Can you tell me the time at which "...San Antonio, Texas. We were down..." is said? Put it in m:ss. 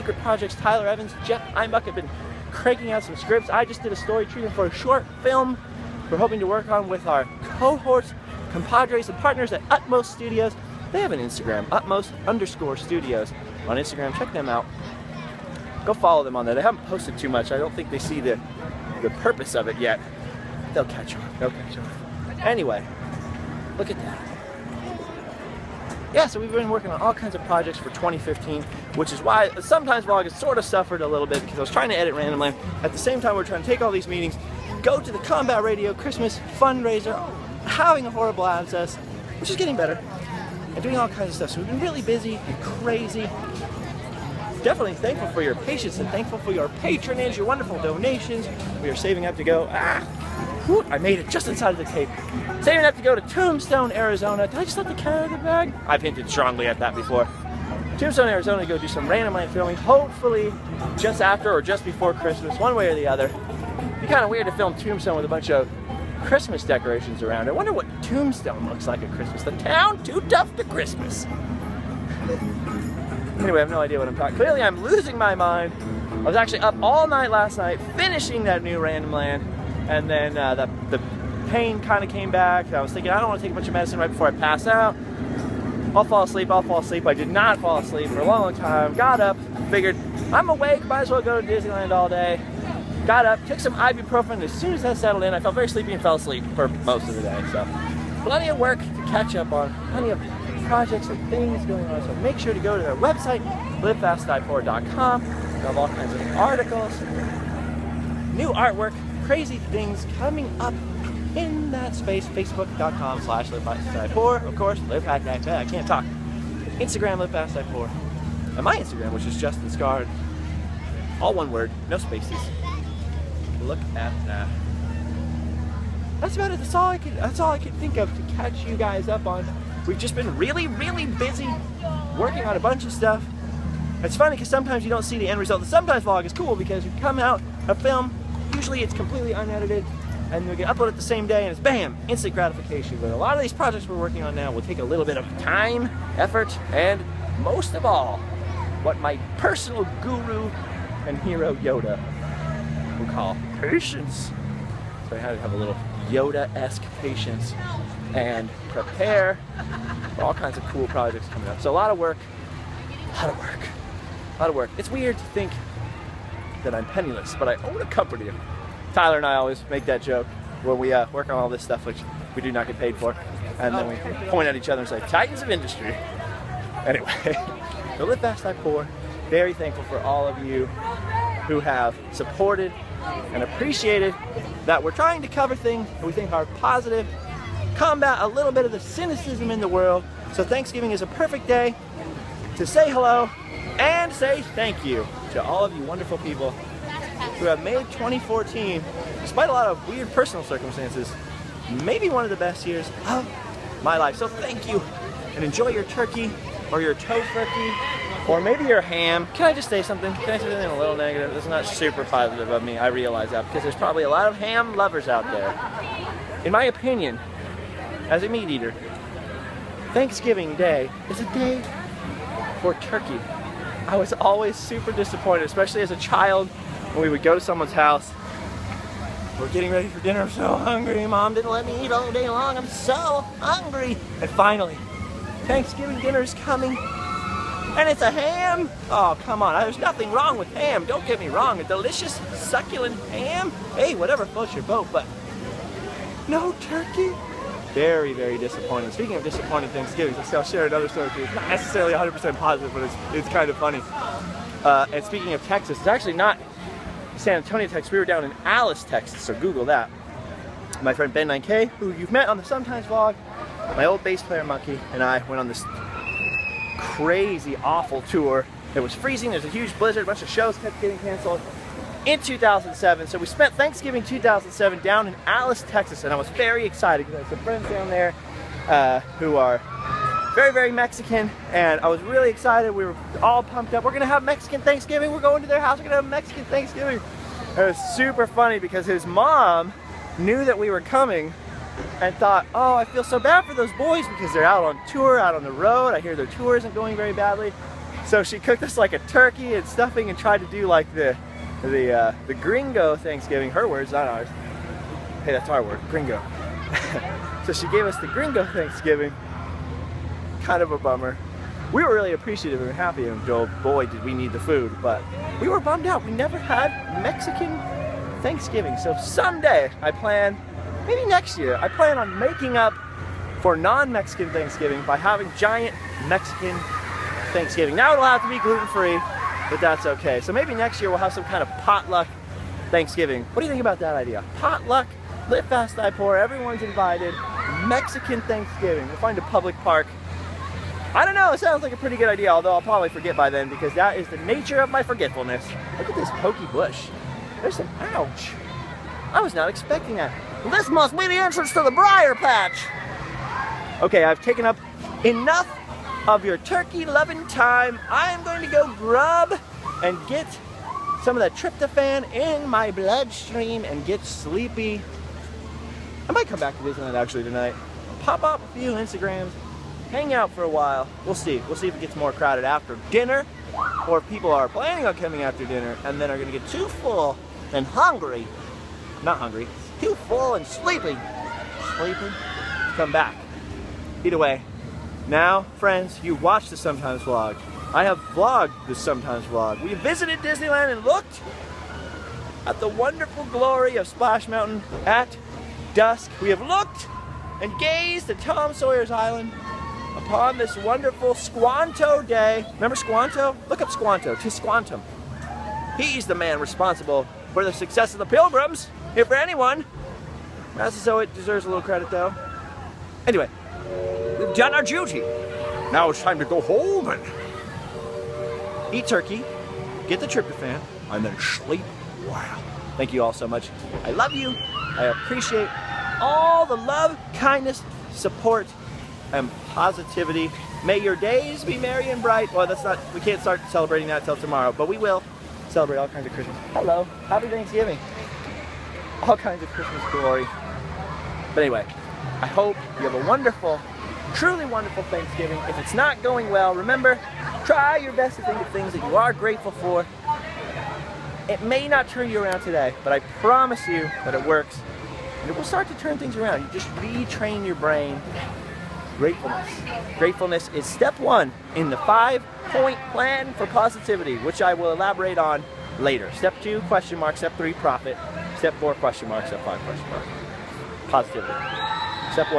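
4:17.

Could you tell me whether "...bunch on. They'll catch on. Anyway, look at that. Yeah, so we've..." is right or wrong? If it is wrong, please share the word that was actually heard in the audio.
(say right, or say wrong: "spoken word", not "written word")
wrong: "catch", not "bunch".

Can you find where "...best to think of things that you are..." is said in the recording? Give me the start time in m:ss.
7:27.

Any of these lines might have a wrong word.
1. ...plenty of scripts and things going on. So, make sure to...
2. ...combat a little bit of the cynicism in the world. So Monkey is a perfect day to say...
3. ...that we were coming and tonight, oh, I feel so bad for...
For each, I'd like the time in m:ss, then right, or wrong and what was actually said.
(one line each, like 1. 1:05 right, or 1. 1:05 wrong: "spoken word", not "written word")
1. 1:39 wrong: "projects", not "scripts"
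2. 3:07 wrong: "Thanksgiving", not "Monkey"
3. 4:50 wrong: "thought", not "tonight".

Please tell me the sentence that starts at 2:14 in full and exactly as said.
It's funny because sometimes you don't see the end result.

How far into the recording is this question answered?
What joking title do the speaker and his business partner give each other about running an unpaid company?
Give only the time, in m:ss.
2:55.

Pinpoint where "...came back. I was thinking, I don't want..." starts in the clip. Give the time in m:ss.
1:22.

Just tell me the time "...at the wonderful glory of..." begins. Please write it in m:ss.
6:32.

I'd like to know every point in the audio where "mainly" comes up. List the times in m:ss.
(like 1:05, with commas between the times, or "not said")
not said.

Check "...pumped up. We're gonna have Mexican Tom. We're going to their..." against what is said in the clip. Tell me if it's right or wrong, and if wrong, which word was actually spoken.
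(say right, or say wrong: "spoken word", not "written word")
wrong: "Thanksgiving", not "Tom".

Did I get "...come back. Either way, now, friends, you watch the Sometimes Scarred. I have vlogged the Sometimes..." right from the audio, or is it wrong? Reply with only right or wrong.
wrong.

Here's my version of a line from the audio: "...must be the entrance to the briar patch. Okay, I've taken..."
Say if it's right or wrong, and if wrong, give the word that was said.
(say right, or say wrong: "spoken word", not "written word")
right.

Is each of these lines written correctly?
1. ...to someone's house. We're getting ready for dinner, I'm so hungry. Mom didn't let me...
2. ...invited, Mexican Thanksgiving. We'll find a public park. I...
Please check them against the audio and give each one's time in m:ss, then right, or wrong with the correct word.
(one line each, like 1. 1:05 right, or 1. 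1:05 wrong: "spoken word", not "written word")
1. 3:47 right
2. 5:36 right.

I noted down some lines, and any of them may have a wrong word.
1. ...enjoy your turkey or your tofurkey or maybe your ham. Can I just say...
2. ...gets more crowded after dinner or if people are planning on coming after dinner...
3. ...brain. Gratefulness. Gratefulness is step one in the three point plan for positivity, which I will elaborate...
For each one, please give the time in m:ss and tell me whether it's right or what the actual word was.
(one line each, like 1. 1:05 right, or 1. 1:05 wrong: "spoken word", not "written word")
1. 3:25 right
2. 6:11 right
3. 7:37 wrong: "five", not "three".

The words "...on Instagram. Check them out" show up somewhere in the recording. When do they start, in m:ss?
0:13.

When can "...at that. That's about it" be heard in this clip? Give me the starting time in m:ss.
2:03.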